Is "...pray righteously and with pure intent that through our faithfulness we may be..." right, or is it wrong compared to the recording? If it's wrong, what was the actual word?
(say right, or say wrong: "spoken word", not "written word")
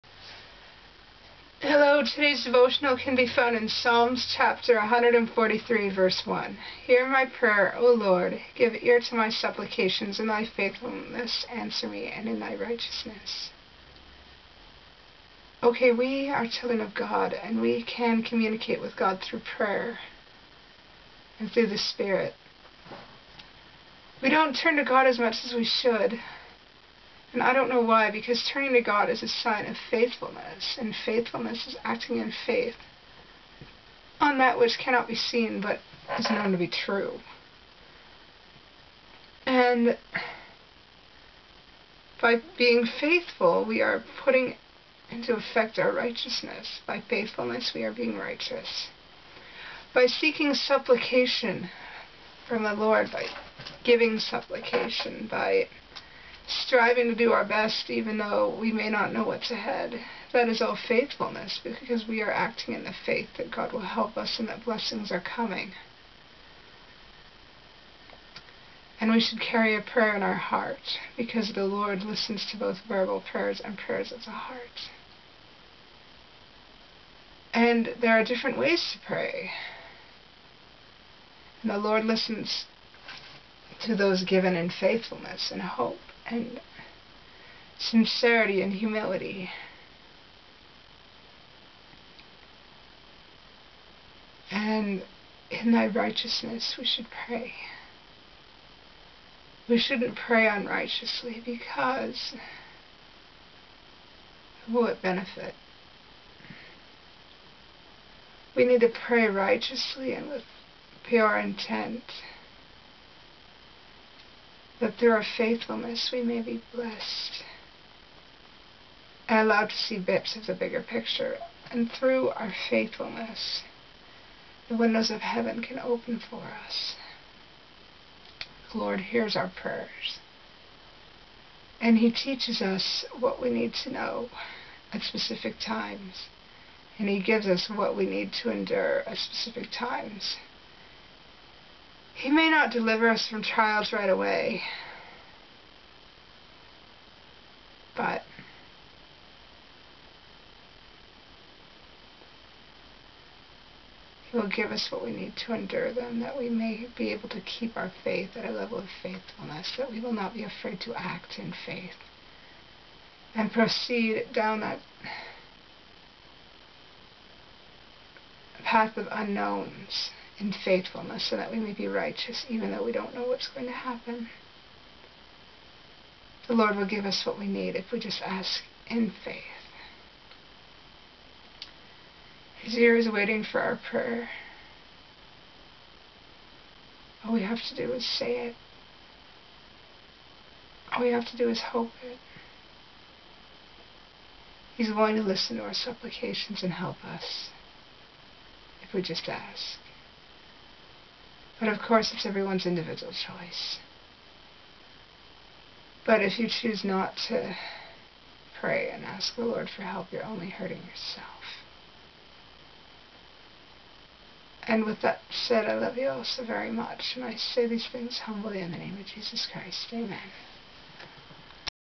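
right.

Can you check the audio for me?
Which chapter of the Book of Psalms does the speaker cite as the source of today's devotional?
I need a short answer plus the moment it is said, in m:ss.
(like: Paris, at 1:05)
143, at 0:04.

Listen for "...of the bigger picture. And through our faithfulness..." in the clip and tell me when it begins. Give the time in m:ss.
2:00.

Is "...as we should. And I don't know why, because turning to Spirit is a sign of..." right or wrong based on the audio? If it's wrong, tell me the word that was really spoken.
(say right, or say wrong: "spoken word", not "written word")
wrong: "God", not "Spirit".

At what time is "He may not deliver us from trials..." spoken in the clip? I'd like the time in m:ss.
2:22.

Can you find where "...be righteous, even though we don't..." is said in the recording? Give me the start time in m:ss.
2:51.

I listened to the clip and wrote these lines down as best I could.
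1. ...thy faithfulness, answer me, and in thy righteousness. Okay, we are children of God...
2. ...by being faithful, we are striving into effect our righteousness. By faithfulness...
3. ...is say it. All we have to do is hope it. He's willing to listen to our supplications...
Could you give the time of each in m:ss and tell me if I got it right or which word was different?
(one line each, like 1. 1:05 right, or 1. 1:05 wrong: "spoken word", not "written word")
1. 0:10 right
2. 0:42 wrong: "putting", not "striving"
3. 3:07 right.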